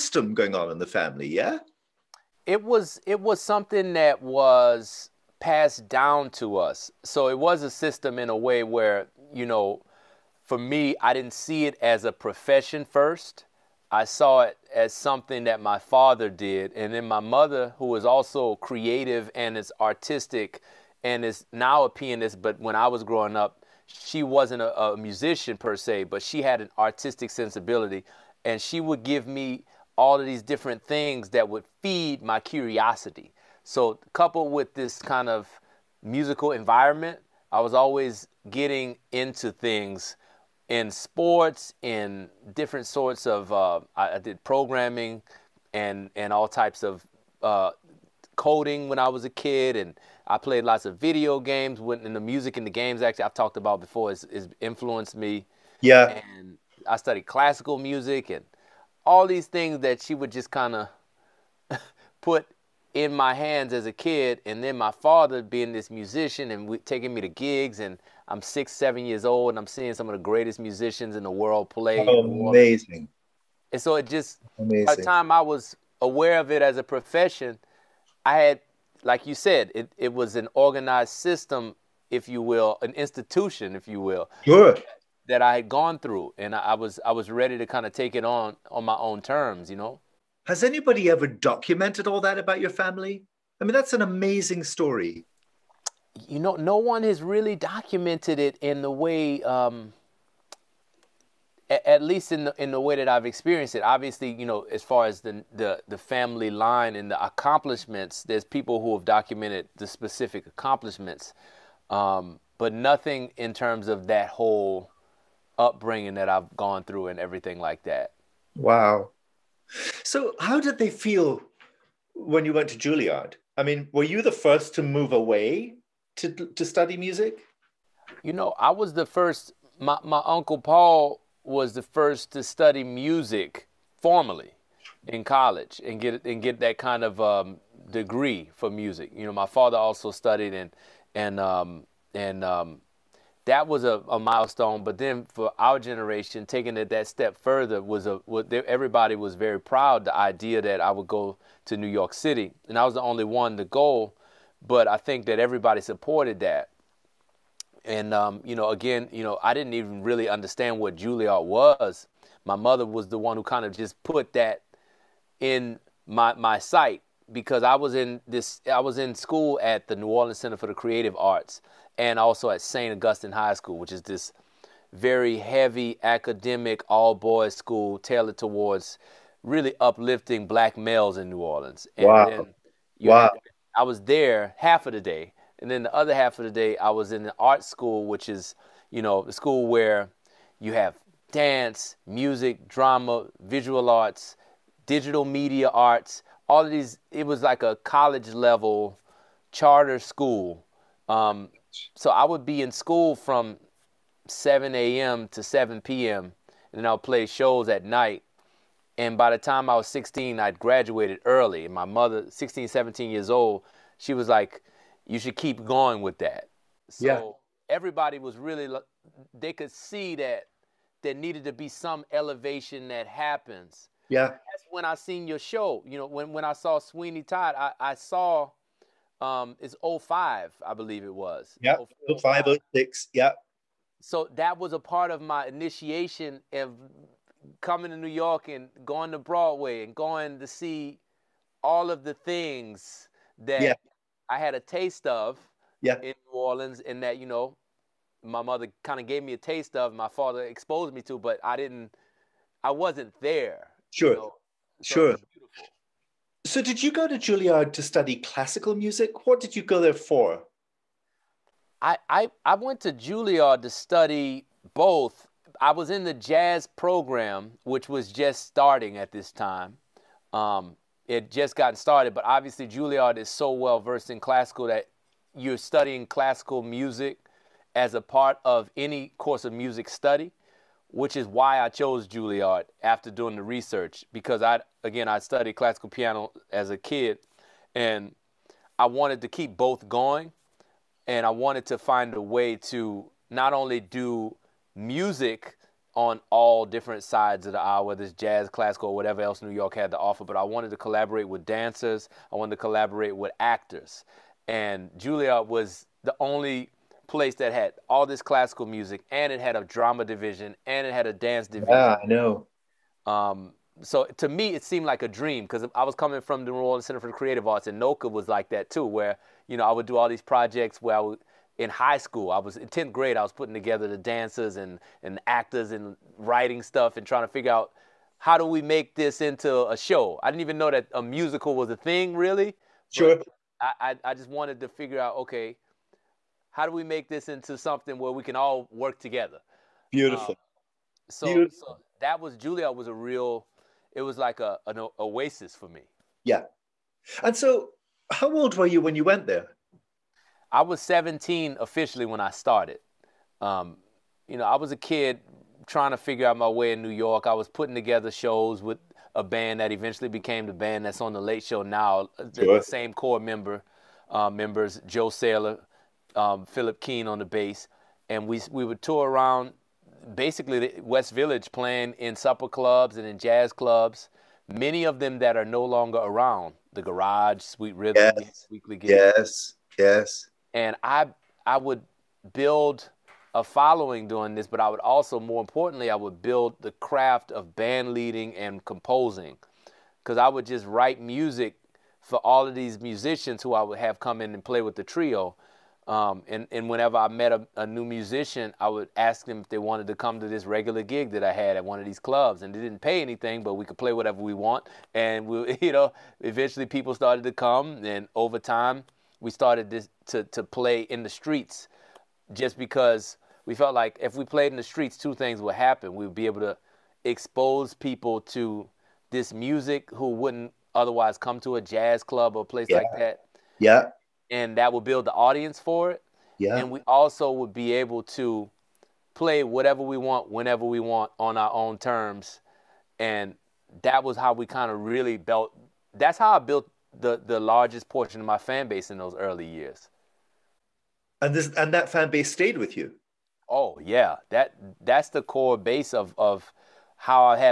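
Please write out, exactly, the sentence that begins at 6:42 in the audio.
And they didn't pay anything, but we could play whatever we want.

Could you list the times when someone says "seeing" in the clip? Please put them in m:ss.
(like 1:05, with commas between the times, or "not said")
1:09.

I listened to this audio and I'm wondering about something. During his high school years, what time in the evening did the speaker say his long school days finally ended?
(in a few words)
7 p.m.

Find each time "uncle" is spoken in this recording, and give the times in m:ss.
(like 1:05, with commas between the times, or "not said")
2:10.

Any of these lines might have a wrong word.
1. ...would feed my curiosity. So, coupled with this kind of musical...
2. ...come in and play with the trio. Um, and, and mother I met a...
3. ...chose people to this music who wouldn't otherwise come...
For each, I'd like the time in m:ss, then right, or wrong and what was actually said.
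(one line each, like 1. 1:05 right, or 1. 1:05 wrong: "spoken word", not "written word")
1. 0:31 right
2. 6:33 wrong: "whenever", not "mother"
3. 6:57 wrong: "expose", not "chose".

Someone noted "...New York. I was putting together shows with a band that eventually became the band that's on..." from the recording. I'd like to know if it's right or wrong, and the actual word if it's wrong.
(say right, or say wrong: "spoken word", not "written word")
right.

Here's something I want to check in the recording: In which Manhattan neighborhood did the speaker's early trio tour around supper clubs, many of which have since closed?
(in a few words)
West Village.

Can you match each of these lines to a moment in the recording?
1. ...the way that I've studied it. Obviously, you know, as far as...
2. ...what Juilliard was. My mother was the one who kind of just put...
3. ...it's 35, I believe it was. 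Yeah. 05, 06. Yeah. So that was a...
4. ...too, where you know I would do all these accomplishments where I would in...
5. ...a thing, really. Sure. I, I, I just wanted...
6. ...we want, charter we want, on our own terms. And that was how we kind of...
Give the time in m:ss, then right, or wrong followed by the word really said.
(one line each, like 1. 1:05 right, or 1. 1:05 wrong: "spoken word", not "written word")
1. 1:42 wrong: "experienced", not "studied"
2. 2:40 right
3. 3:49 wrong: "05", not "35"
4. 5:18 wrong: "projects", not "accomplishments"
5. 5:31 right
6. 7:09 wrong: "whenever", not "charter".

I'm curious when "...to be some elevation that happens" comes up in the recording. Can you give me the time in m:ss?
3:41.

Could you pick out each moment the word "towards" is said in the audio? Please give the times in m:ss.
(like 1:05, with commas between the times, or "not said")
2:58.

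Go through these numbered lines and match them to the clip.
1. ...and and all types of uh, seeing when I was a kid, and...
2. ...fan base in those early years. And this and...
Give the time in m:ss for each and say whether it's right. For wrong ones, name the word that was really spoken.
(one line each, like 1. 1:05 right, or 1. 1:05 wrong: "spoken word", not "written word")
1. 0:45 wrong: "coding", not "seeing"
2. 7:18 right.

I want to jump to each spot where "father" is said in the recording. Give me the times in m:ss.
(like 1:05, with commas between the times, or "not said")
0:15, 1:04, 2:19, 4:10.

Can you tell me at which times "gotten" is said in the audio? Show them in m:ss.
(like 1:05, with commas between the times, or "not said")
4:31.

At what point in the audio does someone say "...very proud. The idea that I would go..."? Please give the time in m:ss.
2:29.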